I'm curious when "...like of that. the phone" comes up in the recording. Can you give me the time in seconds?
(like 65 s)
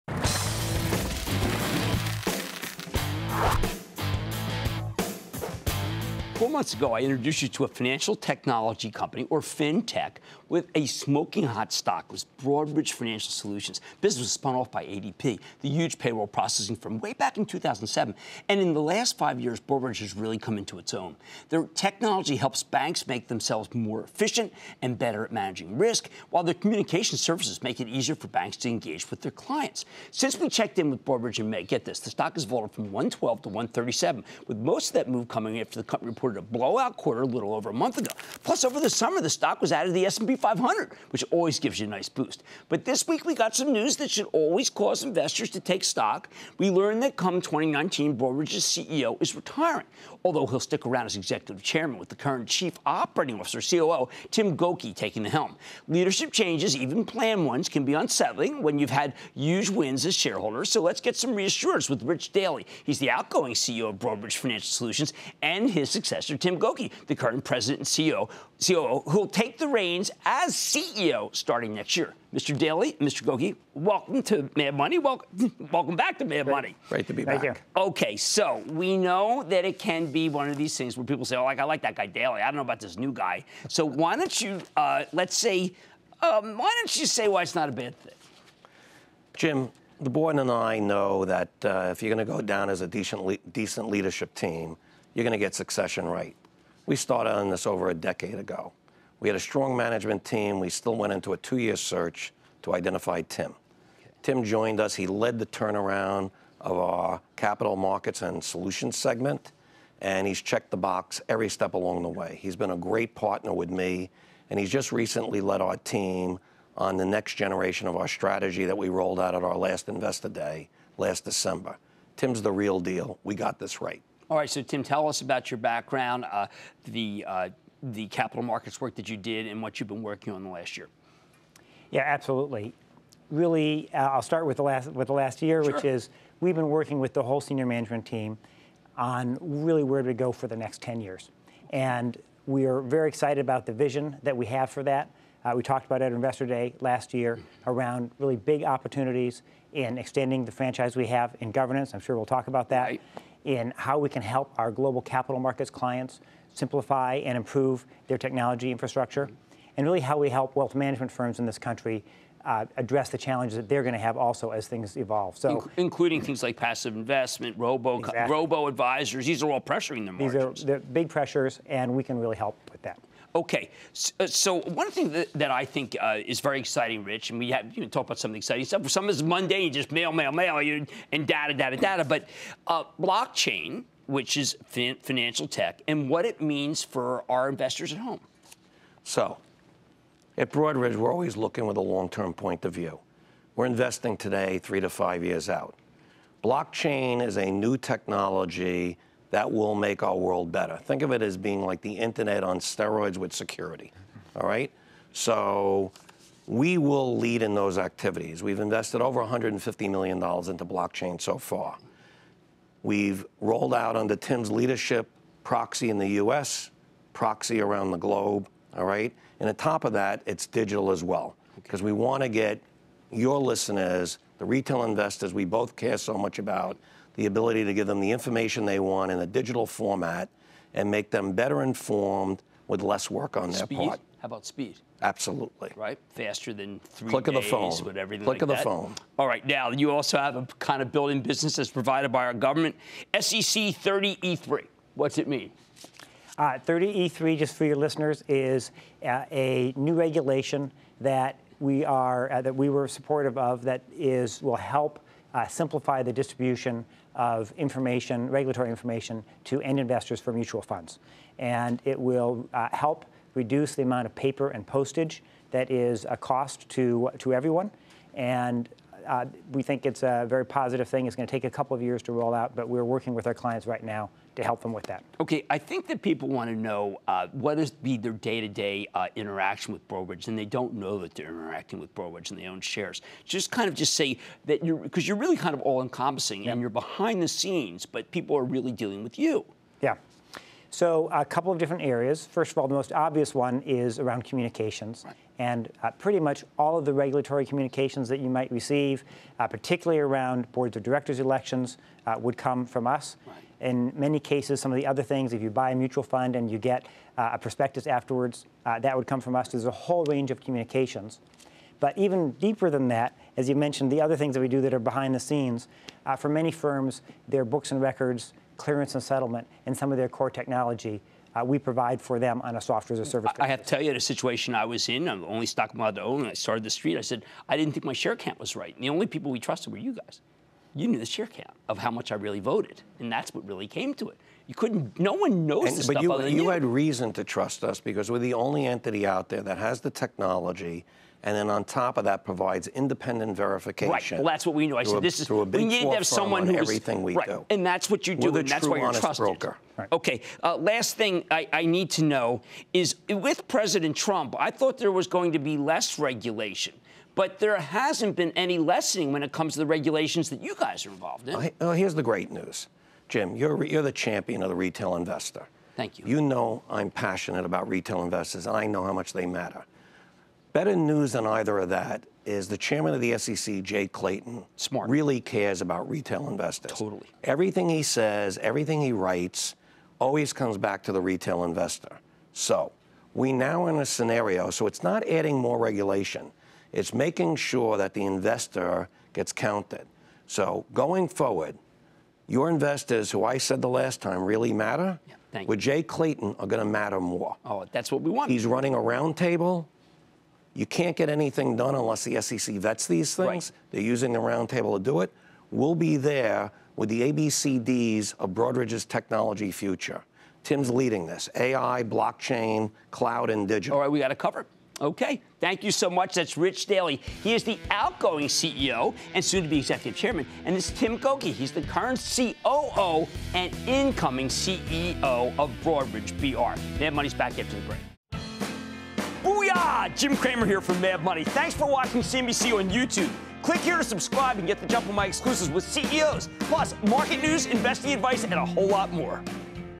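238 s.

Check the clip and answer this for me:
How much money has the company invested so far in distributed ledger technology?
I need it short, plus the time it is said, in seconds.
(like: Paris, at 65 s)
$150 million, at 209 s.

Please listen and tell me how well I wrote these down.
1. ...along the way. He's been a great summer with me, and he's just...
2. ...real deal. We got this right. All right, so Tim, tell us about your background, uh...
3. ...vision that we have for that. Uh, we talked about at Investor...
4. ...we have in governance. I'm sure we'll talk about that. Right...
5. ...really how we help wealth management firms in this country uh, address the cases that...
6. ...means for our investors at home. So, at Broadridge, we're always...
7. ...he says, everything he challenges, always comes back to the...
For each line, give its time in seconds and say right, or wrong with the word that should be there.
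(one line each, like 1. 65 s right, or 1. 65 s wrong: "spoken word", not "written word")
1. 111 s wrong: "partner", not "summer"
2. 122 s right
3. 143 s right
4. 150 s right
5. 159 s wrong: "challenges", not "cases"
6. 186 s right
7. 377 s wrong: "writes", not "challenges".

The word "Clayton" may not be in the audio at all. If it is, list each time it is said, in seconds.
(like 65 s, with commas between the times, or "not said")
373 s, 395 s.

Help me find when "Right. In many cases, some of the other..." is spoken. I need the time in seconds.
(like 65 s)
303 s.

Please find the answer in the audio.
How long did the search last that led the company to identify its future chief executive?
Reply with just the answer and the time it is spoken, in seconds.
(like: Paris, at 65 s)
two year, at 101 s.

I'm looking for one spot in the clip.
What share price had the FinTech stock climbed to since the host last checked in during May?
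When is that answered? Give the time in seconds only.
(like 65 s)
33 s.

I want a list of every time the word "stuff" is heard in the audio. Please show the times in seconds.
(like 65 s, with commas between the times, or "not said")
178 s, 335 s.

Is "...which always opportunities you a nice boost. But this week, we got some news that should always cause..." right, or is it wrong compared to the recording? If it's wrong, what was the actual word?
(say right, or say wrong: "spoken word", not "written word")
wrong: "gives", not "opportunities".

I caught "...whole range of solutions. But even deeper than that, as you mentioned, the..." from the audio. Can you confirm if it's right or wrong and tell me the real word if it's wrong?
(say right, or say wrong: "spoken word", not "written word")
wrong: "communications", not "solutions".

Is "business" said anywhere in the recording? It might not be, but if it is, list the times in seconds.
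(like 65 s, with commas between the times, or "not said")
14 s, 241 s.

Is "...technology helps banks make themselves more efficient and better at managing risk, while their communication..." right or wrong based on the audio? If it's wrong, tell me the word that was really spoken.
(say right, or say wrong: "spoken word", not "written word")
right.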